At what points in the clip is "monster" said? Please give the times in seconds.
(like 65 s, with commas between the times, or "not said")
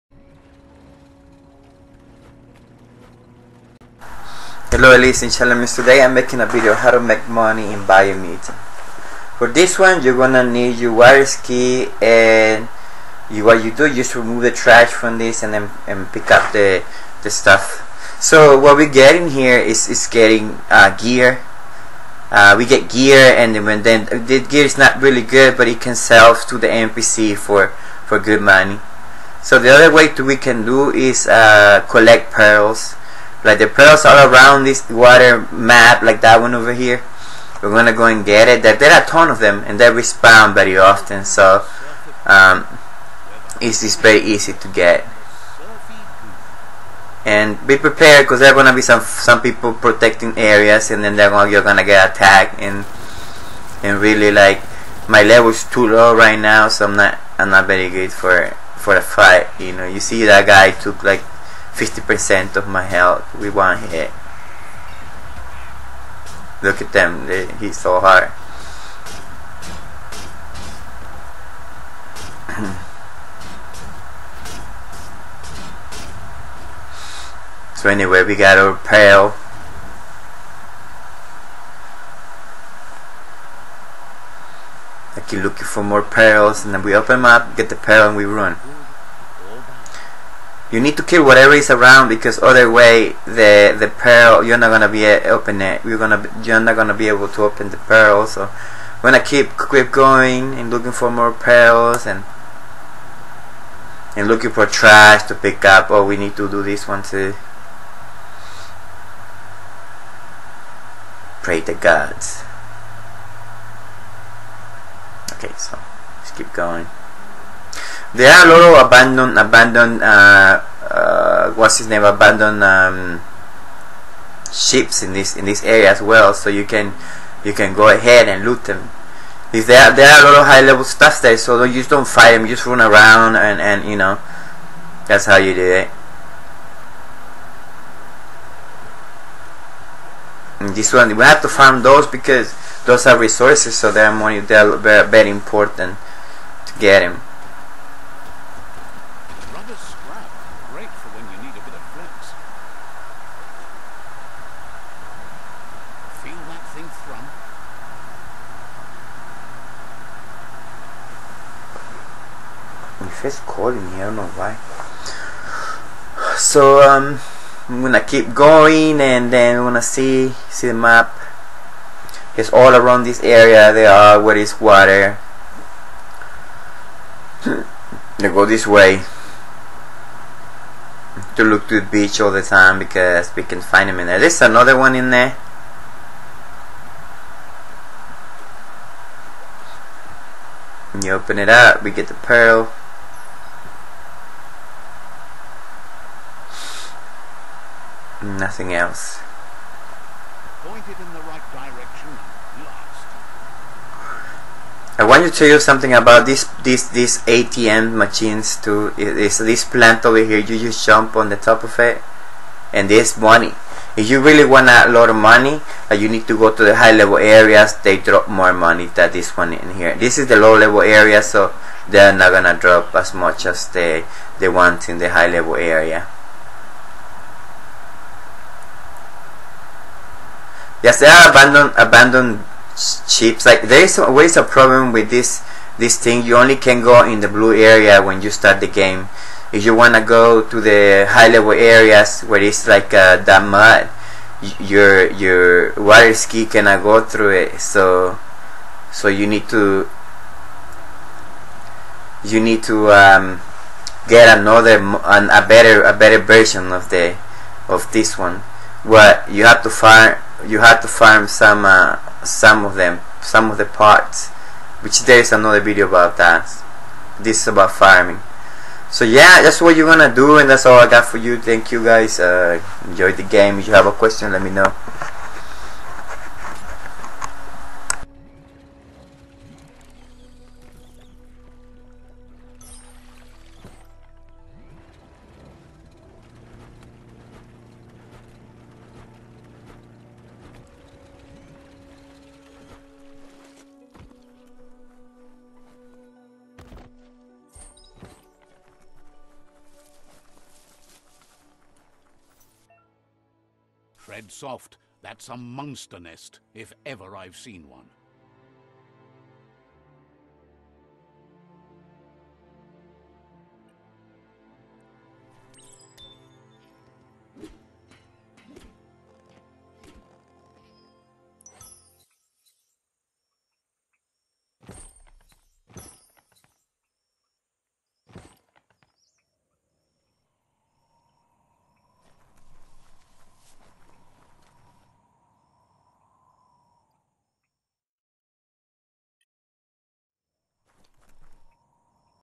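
305 s.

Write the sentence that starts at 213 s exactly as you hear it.
If you really want a lot of money, uh, you need to go to the high level areas.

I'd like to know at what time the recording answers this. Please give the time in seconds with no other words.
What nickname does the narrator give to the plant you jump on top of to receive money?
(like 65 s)
207 s.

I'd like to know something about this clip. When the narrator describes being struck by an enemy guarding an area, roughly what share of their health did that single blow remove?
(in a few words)
50%.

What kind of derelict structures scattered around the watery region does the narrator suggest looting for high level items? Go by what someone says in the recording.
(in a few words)
abandoned ships.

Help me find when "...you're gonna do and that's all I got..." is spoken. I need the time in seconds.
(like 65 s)
269 s.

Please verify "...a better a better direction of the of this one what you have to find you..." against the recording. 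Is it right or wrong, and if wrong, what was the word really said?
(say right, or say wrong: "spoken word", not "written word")
wrong: "version", not "direction".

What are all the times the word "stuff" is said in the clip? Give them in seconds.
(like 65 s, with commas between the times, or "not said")
17 s, 130 s.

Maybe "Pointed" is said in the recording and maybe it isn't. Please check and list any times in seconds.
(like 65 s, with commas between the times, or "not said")
200 s.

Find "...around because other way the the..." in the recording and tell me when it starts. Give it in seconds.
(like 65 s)
91 s.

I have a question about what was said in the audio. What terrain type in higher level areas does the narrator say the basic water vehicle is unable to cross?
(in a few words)
mud.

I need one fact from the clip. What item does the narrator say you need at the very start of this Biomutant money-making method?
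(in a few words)
wireless key.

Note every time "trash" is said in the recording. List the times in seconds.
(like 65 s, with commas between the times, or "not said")
14 s, 104 s.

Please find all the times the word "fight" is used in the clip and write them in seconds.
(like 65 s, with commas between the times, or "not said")
59 s, 132 s.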